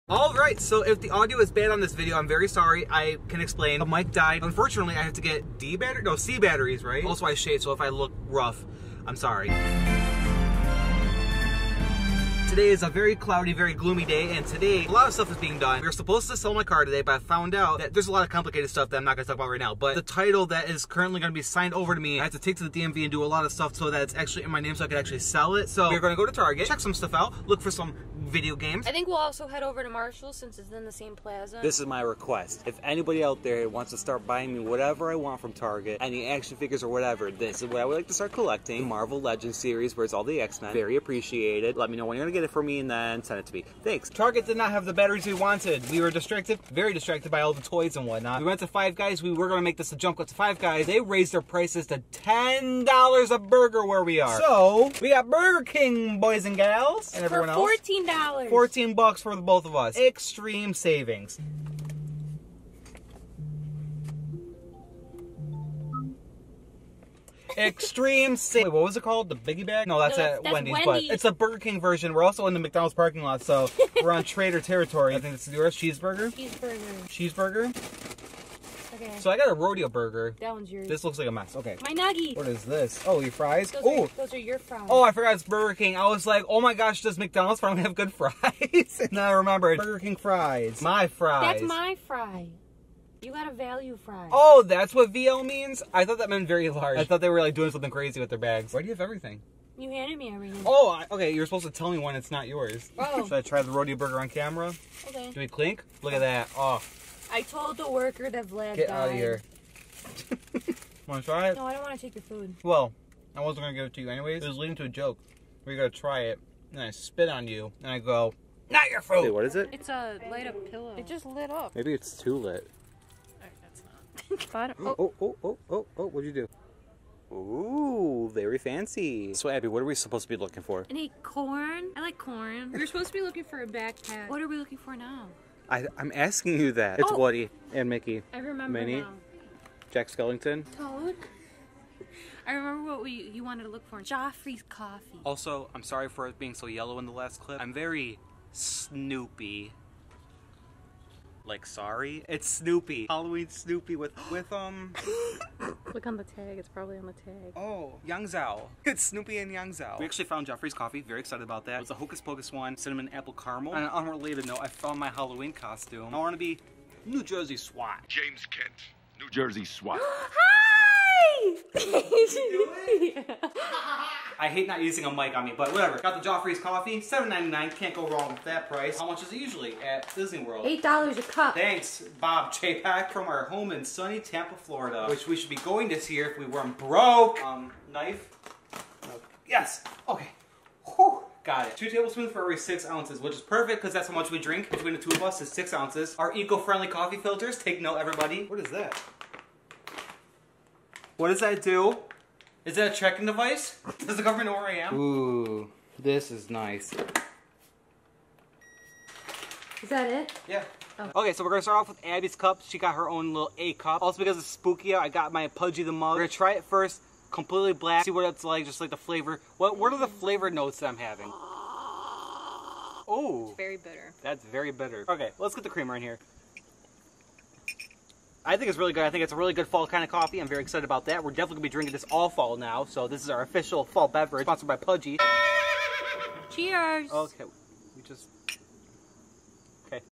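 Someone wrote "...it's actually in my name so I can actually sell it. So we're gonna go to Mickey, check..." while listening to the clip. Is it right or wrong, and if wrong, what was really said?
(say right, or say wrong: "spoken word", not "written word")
wrong: "Target", not "Mickey".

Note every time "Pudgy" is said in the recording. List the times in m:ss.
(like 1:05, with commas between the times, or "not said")
3:35, 3:54.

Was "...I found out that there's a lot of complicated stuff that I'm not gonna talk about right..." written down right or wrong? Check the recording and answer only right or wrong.
right.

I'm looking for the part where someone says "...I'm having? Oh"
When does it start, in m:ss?
3:40.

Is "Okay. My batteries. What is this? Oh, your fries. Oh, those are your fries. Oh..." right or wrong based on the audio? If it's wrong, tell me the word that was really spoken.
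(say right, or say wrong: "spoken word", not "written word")
wrong: "nuggies", not "batteries".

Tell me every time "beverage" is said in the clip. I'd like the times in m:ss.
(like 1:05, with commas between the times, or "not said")
3:54.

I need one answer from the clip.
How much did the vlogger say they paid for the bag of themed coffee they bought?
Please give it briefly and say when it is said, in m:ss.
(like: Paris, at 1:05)
$7.99, at 2:56.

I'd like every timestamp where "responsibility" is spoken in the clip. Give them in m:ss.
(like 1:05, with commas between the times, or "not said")
not said.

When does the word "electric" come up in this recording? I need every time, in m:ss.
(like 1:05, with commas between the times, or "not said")
not said.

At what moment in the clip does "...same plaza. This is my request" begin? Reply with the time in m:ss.
0:30.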